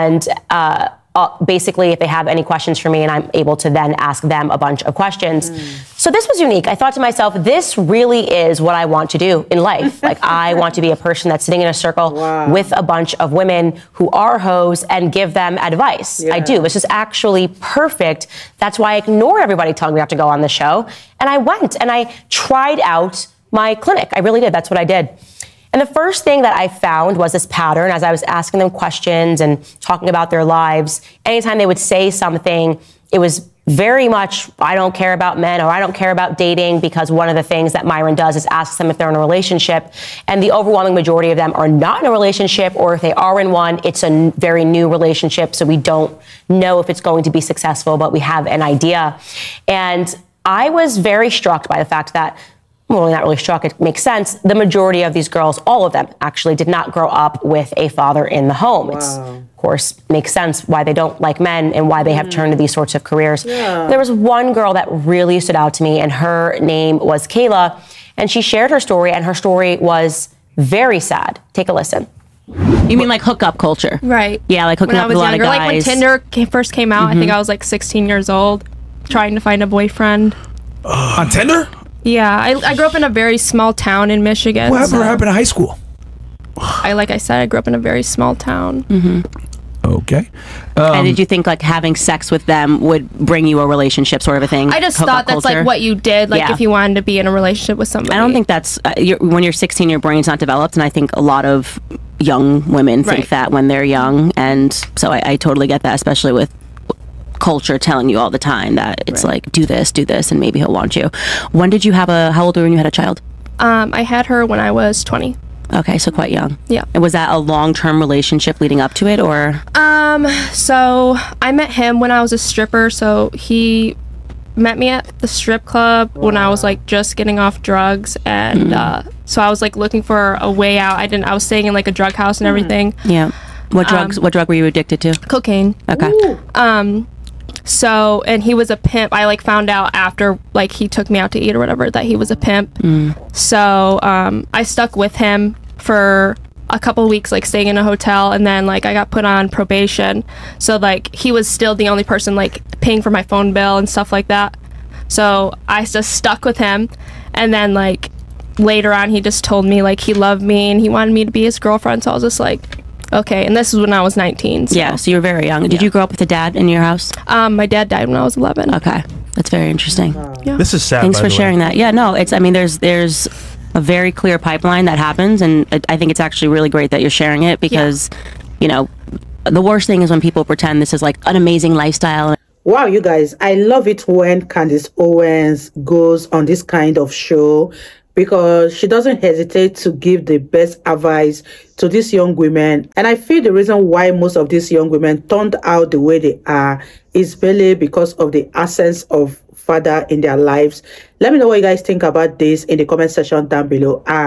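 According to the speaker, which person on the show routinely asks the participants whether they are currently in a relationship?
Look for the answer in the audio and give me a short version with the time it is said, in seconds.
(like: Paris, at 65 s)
Myron, at 37 s.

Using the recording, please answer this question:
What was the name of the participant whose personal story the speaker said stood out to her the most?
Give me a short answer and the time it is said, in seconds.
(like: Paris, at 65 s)
Kayla, at 67 s.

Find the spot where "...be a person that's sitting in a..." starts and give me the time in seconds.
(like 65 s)
10 s.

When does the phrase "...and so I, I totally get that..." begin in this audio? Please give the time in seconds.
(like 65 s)
104 s.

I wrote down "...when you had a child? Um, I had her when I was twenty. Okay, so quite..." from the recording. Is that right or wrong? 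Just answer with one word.
right.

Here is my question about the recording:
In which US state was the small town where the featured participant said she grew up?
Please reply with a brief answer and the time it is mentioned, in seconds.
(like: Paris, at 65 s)
Michigan, at 84 s.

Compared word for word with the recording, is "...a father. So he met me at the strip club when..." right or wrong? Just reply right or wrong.
wrong.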